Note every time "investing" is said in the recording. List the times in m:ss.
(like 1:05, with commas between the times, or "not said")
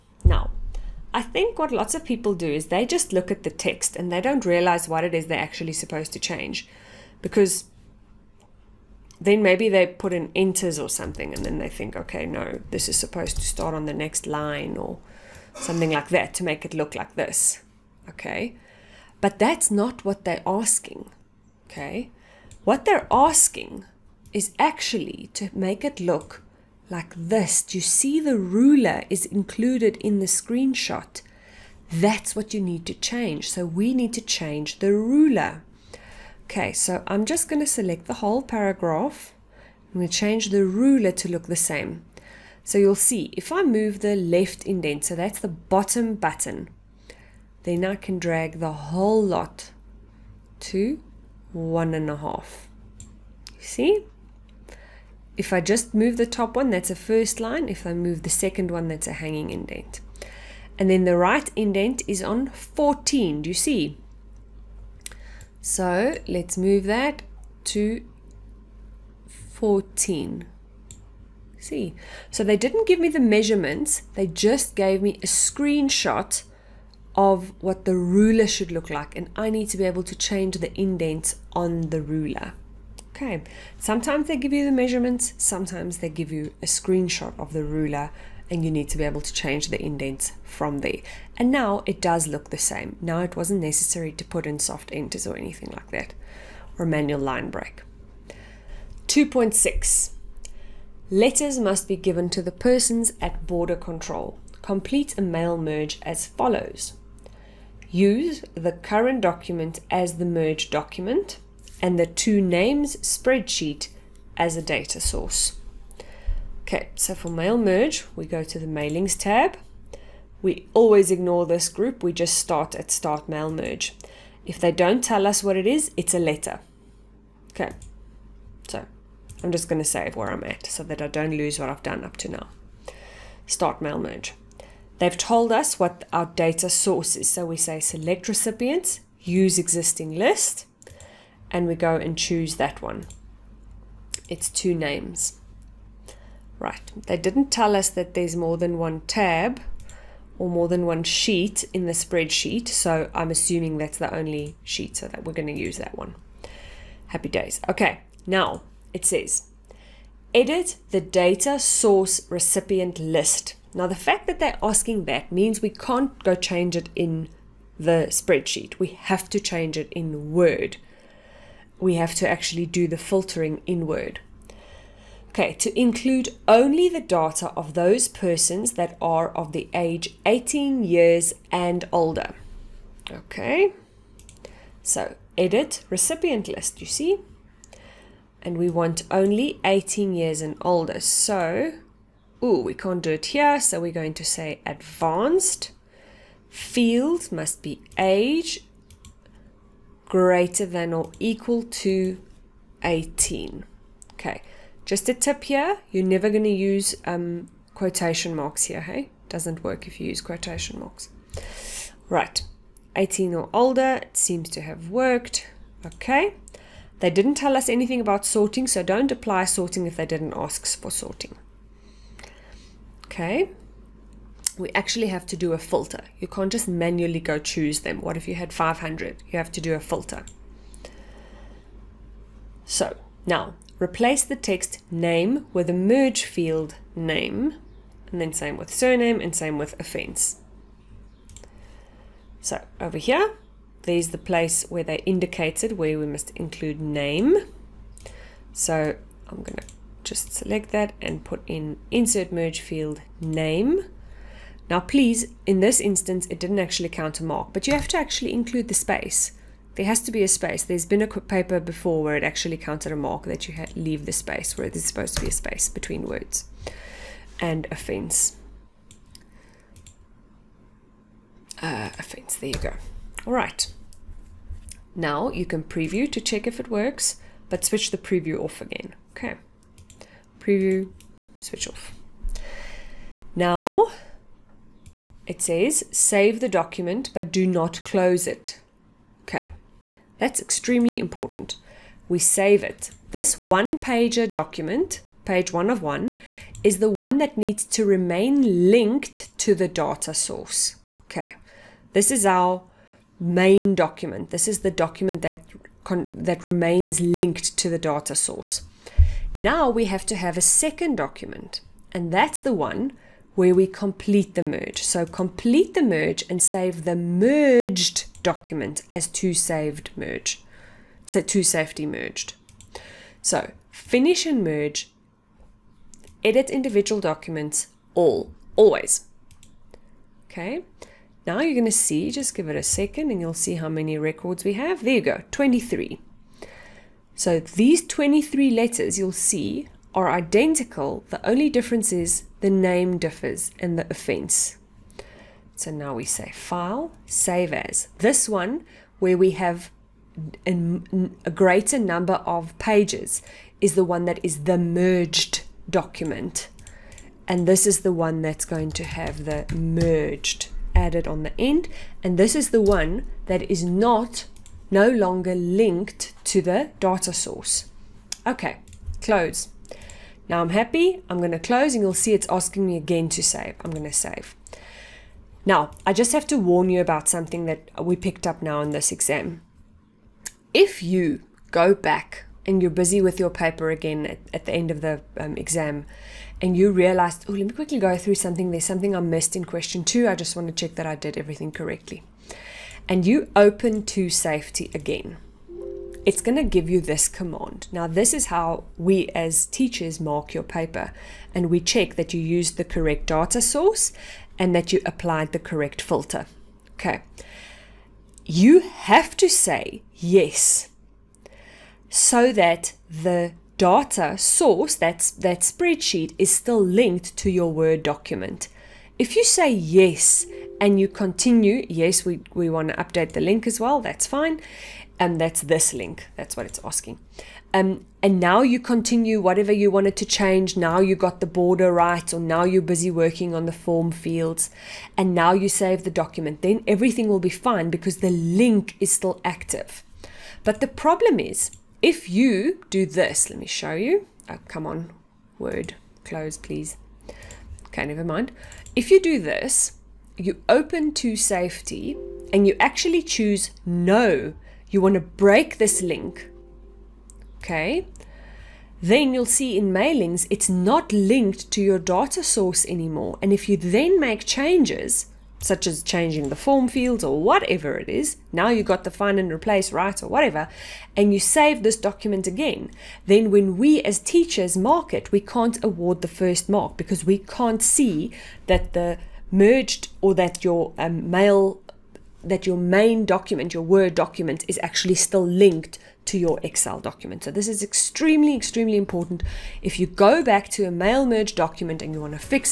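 not said.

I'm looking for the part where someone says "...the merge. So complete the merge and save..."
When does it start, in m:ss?
5:14.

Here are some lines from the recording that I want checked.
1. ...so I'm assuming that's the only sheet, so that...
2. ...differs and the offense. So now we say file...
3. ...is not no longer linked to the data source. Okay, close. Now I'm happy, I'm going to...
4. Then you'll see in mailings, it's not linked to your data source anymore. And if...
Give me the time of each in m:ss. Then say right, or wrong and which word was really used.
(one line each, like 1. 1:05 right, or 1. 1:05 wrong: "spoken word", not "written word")
1. 2:32 right
2. 5:42 right
3. 6:03 right
4. 7:38 right.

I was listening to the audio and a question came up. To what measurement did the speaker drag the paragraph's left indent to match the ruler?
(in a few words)
1.5.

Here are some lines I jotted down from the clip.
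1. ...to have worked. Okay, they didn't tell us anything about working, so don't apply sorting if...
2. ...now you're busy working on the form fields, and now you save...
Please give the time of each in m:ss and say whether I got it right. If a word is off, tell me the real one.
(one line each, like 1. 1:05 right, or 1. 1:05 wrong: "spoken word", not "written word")
1. 3:34 wrong: "sorting", not "working"
2. 7:12 right.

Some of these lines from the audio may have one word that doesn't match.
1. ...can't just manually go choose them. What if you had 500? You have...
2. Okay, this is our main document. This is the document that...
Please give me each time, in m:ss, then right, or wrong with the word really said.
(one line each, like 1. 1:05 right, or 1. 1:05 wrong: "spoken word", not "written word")
1. 3:46 right
2. 5:01 right.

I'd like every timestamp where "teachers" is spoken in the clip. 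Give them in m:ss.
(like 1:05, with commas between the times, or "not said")
6:39, 7:53.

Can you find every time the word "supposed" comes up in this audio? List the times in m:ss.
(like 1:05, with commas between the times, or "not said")
0:05, 0:12, 4:24.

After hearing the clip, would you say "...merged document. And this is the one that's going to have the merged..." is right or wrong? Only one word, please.
right.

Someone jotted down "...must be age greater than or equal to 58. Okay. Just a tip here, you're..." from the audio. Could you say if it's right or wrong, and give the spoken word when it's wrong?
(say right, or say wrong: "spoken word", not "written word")
wrong: "18", not "58".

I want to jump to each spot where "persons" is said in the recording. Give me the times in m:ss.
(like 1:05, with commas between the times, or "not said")
1:42, 2:58.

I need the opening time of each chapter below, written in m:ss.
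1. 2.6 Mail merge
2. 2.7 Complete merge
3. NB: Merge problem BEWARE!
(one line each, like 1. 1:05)
1. 1:38
2. 5:12
3. 6:14.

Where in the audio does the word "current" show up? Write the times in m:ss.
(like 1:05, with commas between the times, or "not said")
1:48.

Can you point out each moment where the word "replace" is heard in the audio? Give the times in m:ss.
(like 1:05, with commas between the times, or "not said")
3:53, 7:49.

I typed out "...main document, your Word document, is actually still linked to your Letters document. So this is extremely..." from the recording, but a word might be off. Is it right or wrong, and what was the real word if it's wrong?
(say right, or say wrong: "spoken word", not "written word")
wrong: "Excel", not "Letters".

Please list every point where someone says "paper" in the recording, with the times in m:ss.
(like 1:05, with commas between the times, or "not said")
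4:21, 6:23, 6:40.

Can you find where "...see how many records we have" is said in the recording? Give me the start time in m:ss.
5:33.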